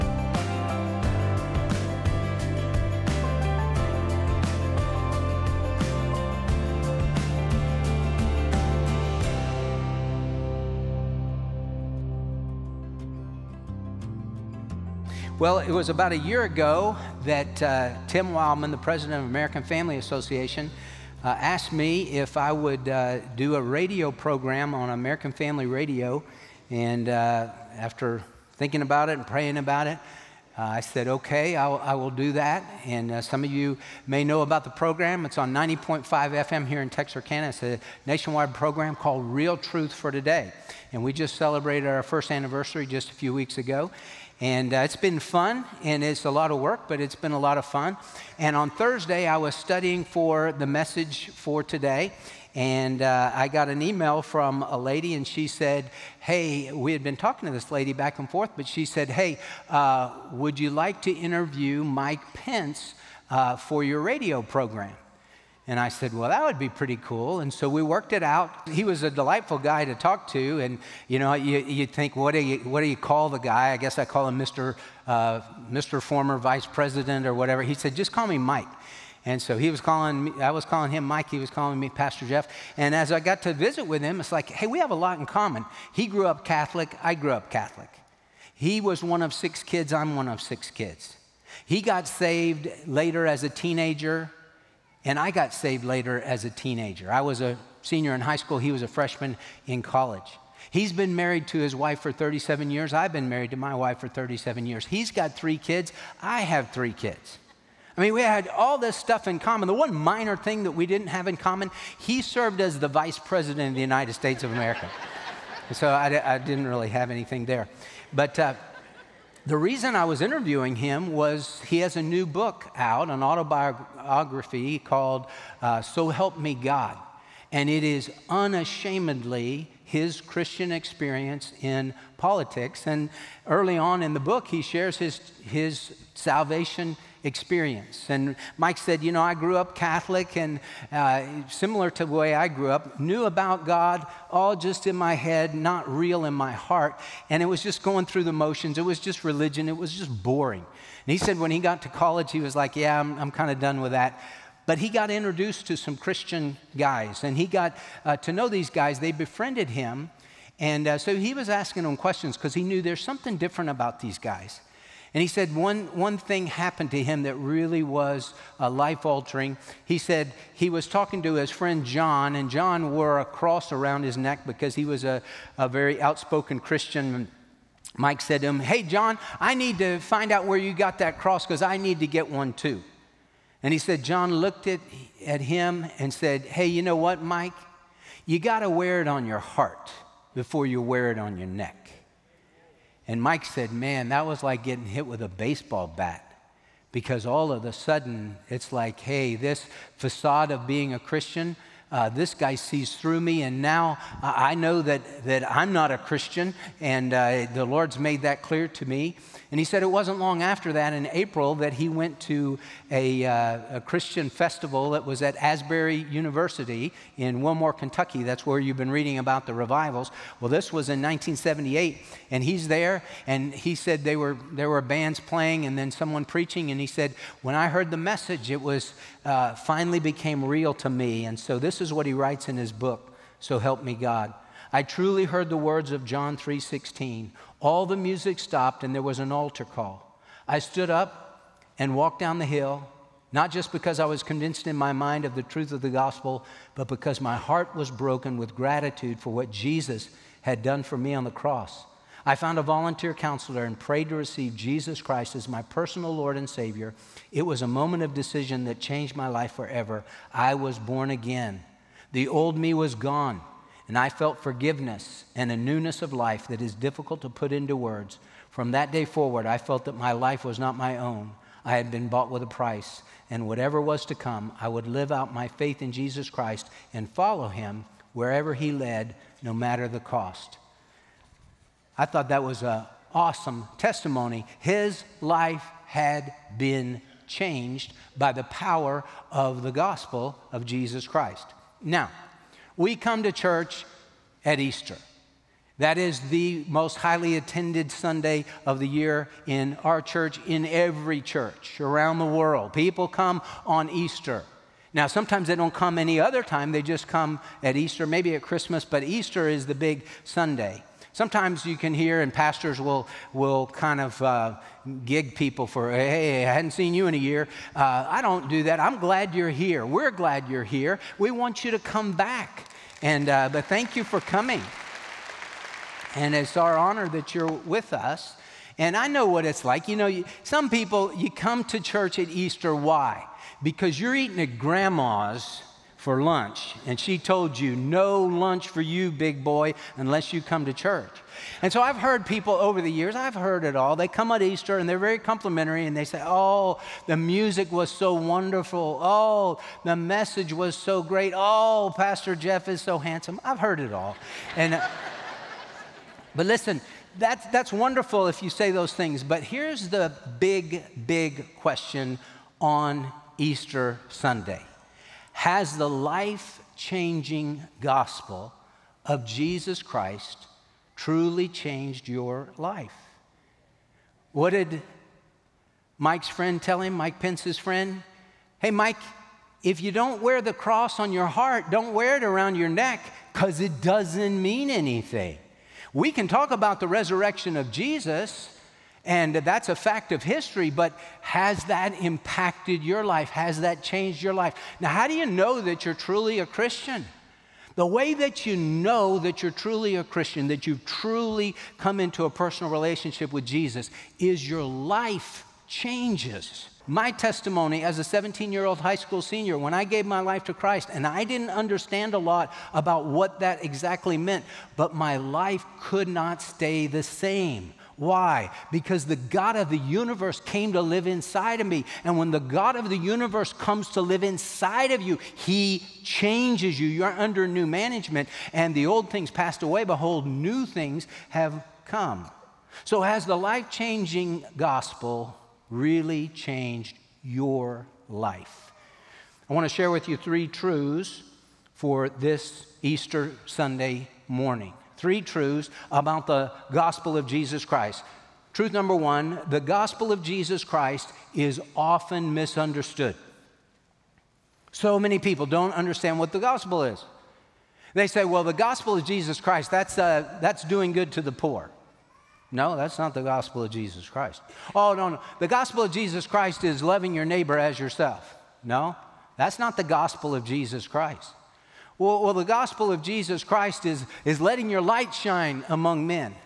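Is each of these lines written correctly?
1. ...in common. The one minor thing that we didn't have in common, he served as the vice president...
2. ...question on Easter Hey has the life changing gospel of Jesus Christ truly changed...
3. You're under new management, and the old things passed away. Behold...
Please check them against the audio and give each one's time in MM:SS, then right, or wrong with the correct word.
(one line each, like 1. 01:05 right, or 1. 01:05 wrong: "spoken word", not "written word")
1. 01:49 right
2. 06:01 wrong: "Sunday", not "Hey"
3. 07:06 right.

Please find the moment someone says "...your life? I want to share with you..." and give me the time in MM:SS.
07:17.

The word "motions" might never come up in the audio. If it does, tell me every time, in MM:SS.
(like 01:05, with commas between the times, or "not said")
02:28.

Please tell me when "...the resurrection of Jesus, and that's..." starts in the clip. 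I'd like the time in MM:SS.
06:26.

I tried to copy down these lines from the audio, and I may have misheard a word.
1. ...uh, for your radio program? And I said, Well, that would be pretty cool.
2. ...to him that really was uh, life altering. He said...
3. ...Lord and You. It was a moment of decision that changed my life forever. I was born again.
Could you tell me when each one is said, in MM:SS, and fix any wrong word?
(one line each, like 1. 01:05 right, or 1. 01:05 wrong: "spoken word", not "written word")
1. 01:03 right
2. 02:46 right
3. 04:16 wrong: "Savior", not "You".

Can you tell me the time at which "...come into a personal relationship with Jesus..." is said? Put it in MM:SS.
06:41.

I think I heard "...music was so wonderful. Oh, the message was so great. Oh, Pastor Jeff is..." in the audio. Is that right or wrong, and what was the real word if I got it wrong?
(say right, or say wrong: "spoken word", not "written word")
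right.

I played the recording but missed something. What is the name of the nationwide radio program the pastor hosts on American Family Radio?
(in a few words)
Real Truth for Today.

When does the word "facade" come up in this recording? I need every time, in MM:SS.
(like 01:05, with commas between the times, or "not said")
03:19.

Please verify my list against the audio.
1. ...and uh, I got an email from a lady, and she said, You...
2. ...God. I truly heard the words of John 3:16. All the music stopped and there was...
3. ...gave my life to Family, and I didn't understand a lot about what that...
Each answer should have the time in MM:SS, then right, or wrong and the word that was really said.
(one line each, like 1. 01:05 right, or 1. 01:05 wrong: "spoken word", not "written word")
1. 00:52 wrong: "Hey", not "You"
2. 03:53 right
3. 06:49 wrong: "Christ", not "Family".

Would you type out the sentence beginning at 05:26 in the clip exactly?
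And it's our honor that you're with us.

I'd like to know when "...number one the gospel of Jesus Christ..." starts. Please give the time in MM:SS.
07:28.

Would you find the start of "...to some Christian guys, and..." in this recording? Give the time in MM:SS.
02:35.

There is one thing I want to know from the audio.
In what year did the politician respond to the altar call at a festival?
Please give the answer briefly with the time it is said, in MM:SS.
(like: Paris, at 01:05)
1978, at 03:41.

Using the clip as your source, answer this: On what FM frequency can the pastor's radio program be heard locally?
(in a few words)
90.5 FM.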